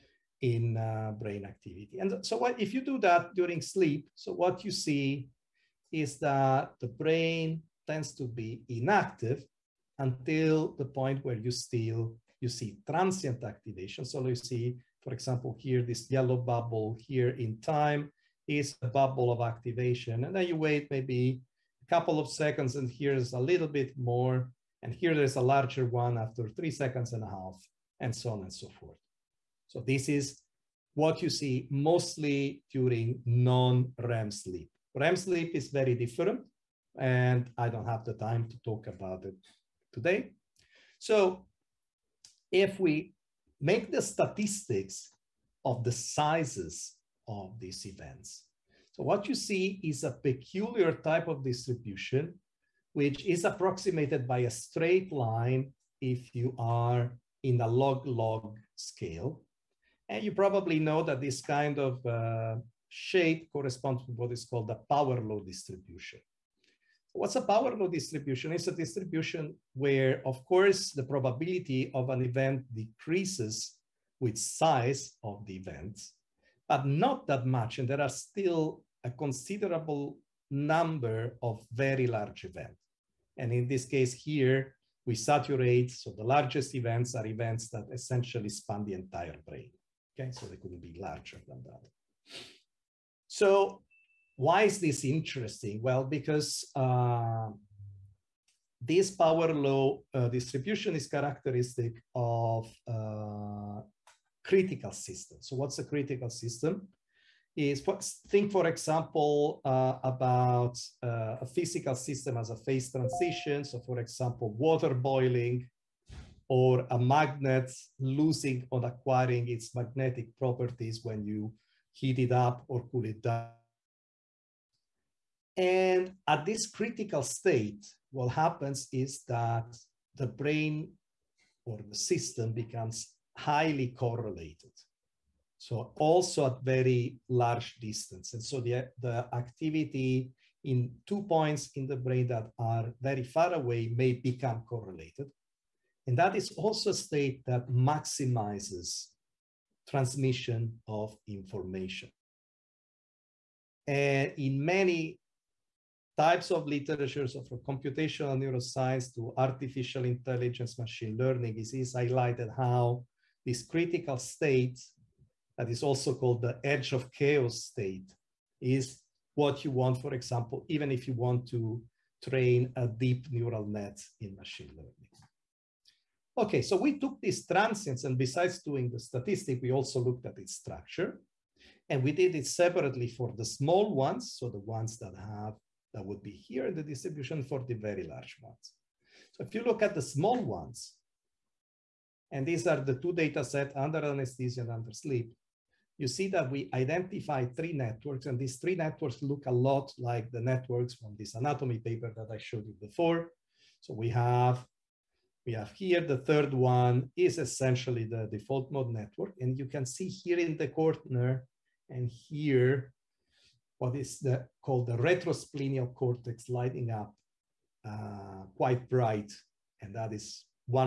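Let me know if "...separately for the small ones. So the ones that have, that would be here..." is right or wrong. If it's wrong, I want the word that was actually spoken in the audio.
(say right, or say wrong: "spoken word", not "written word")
right.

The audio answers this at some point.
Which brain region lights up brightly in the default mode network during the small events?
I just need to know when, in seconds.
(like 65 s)
214 s.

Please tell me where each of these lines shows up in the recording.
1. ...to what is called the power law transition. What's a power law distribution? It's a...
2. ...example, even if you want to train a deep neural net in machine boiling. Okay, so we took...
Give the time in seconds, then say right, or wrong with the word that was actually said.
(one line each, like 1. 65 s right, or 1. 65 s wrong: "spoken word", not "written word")
1. 64 s wrong: "distribution", not "transition"
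2. 170 s wrong: "learning", not "boiling".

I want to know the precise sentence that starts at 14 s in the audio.
So you see, for example, here, this yellow bubble here in time is a bubble of activation.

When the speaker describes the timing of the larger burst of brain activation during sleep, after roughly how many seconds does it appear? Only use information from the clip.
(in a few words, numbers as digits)
3.5 seconds.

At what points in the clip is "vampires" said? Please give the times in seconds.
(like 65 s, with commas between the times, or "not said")
not said.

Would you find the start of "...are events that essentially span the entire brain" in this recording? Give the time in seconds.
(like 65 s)
87 s.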